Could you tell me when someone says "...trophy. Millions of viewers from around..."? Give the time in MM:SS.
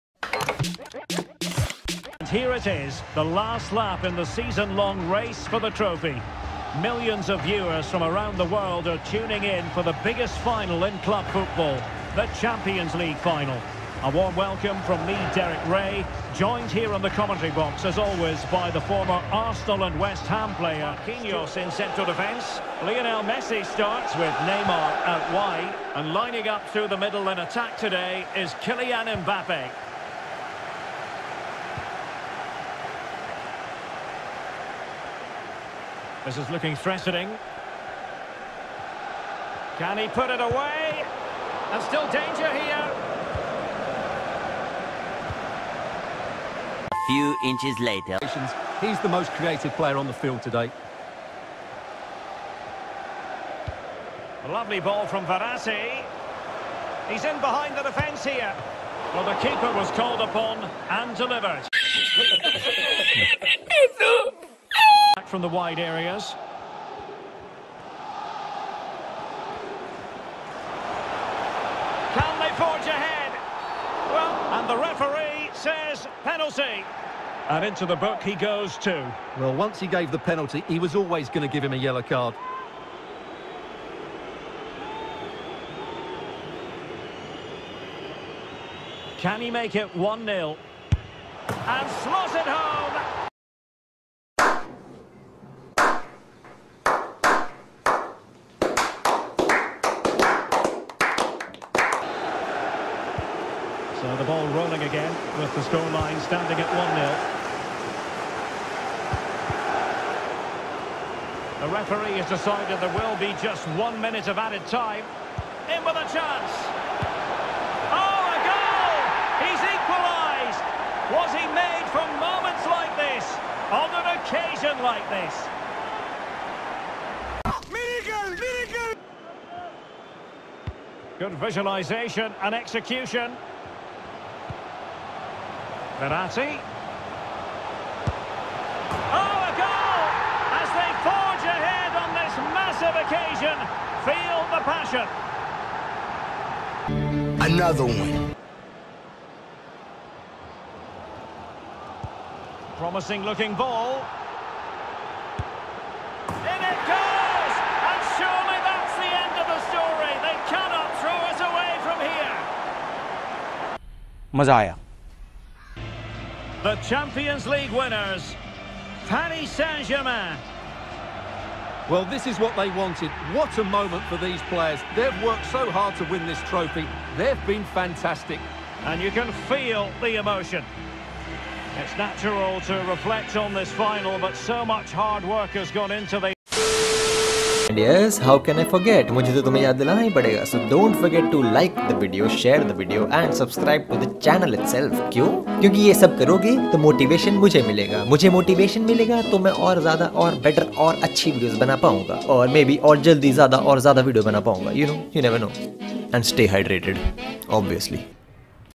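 00:05.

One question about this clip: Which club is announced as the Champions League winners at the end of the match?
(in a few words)
Paris Saint-Germain.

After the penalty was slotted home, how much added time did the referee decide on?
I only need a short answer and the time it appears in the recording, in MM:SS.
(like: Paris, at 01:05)
1 minute, at 01:53.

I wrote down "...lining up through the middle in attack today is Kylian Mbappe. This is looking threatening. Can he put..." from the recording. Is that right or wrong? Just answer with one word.
right.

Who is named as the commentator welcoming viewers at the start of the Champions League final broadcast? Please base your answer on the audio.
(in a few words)
Derek Rae.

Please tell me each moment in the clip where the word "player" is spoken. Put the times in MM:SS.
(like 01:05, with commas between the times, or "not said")
00:20, 00:49, 02:54.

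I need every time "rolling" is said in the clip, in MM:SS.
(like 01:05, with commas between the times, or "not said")
01:44.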